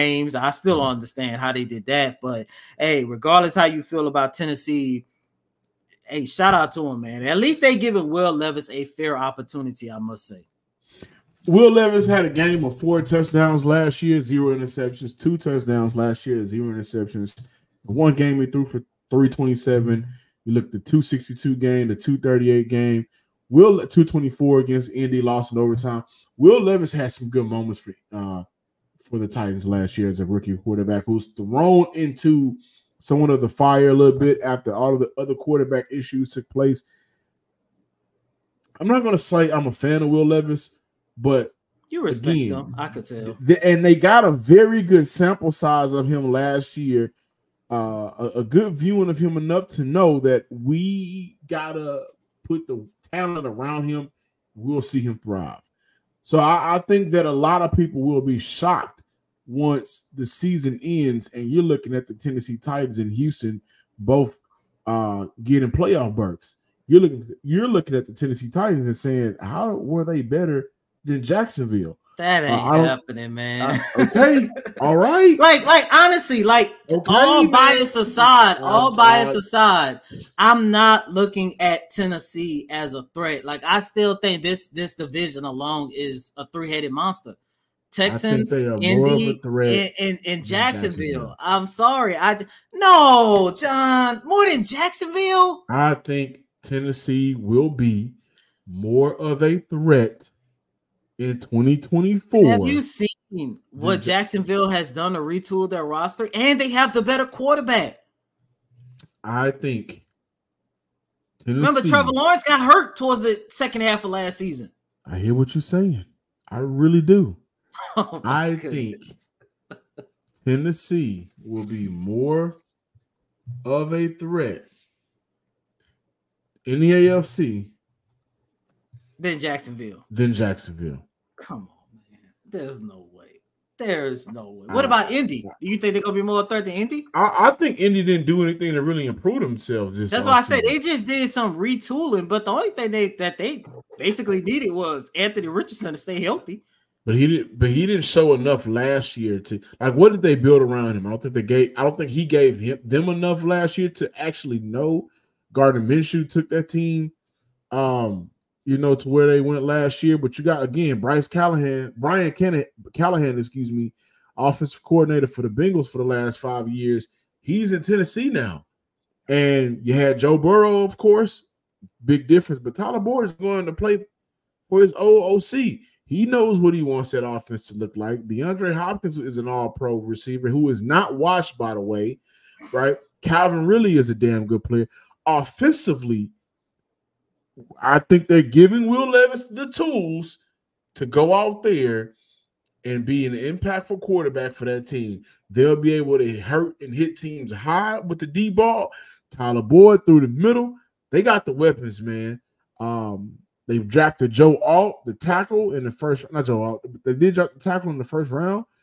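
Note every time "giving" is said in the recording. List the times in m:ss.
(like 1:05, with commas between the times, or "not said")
0:07, 3:08.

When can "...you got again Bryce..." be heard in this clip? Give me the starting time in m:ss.
2:40.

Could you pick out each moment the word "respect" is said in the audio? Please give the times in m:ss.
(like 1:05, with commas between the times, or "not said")
0:42.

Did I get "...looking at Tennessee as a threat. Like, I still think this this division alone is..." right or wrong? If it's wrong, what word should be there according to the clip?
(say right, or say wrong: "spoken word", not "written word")
right.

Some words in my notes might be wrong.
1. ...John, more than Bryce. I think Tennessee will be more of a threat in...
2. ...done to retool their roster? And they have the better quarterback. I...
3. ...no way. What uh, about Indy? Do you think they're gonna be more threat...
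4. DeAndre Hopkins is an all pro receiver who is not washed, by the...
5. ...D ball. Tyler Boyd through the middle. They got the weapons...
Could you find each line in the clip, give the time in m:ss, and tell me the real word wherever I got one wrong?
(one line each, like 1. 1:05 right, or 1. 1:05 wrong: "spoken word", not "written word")
1. 1:33 wrong: "Jacksonville", not "Bryce"
2. 1:44 right
3. 2:14 right
4. 2:58 right
5. 3:18 right.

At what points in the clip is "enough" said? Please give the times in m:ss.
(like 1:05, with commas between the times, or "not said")
0:49, 2:28, 2:33.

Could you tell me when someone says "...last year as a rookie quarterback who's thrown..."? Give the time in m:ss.
0:29.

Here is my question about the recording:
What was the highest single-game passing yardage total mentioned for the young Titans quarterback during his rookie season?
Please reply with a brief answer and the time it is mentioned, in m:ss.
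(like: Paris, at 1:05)
327, at 0:19.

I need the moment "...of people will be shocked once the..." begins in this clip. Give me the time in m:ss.
0:57.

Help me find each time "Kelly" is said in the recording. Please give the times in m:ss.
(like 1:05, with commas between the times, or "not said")
not said.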